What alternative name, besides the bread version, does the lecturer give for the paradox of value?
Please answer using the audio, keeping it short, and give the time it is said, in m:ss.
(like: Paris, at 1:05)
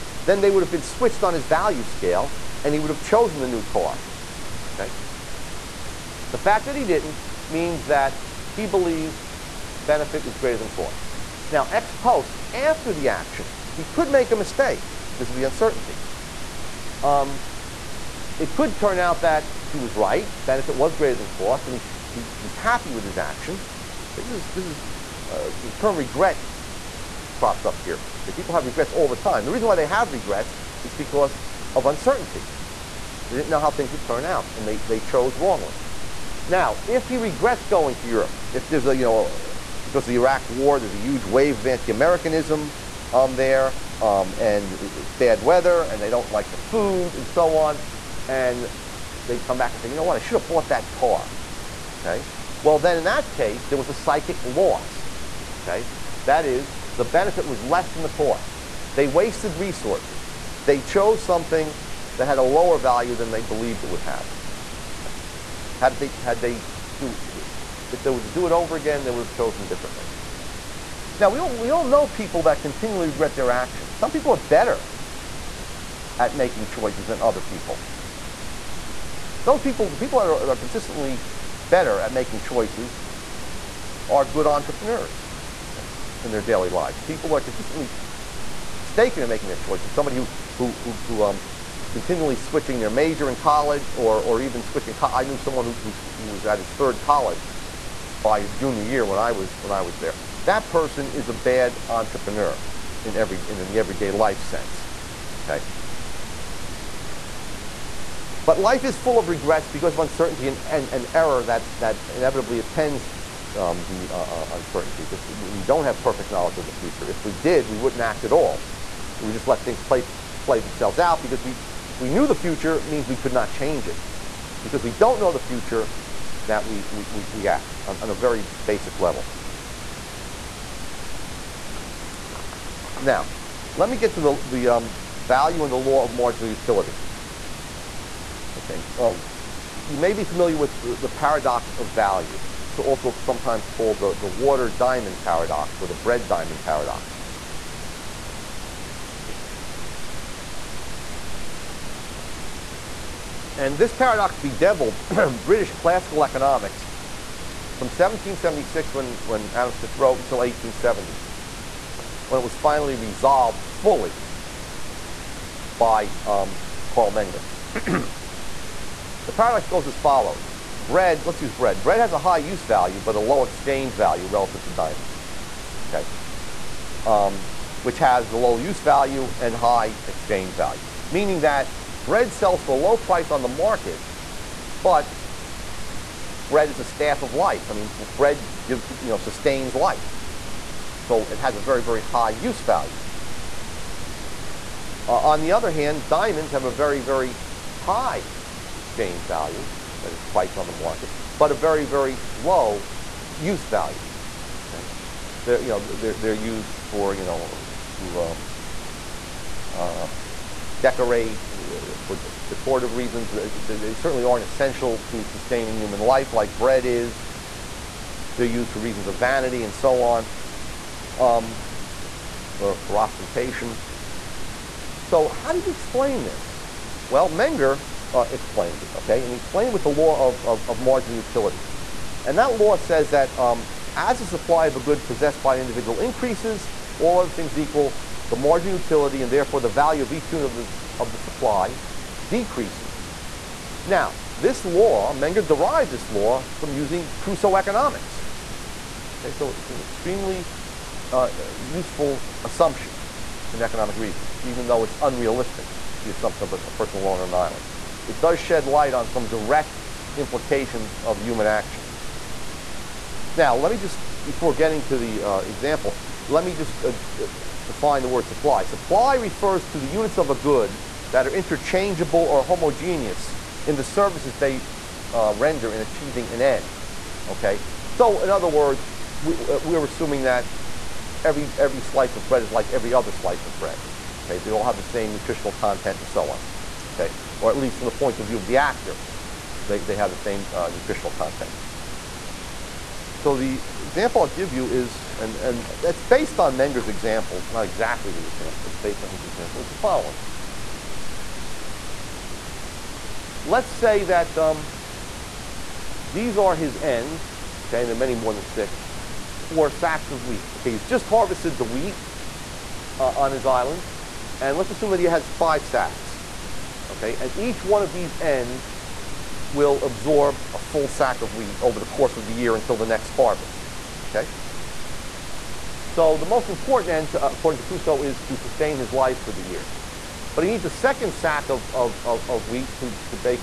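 water diamond paradox, at 2:24.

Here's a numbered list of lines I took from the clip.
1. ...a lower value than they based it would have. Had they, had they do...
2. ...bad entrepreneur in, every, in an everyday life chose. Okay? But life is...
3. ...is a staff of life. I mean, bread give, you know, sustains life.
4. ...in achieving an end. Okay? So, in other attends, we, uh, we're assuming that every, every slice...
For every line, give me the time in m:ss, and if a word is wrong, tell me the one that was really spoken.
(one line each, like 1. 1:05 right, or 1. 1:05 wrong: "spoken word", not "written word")
1. 1:02 wrong: "believed", not "based"
2. 1:41 wrong: "sense", not "chose"
3. 3:06 right
4. 4:35 wrong: "words", not "attends".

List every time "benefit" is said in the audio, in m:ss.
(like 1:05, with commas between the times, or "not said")
0:09, 0:20, 0:57.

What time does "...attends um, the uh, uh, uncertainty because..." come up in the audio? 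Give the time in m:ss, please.
1:52.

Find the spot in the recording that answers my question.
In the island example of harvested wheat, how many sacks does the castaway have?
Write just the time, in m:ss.
5:15.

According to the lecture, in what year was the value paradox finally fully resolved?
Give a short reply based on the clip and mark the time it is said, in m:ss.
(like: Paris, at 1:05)
1870, at 2:40.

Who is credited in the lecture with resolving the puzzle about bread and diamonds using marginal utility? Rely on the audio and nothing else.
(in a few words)
Karl Menger.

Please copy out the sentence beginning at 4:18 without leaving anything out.
It does shed light on some direct implications of human action.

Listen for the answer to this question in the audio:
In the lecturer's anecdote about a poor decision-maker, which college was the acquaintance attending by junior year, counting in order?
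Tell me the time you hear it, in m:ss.
1:36.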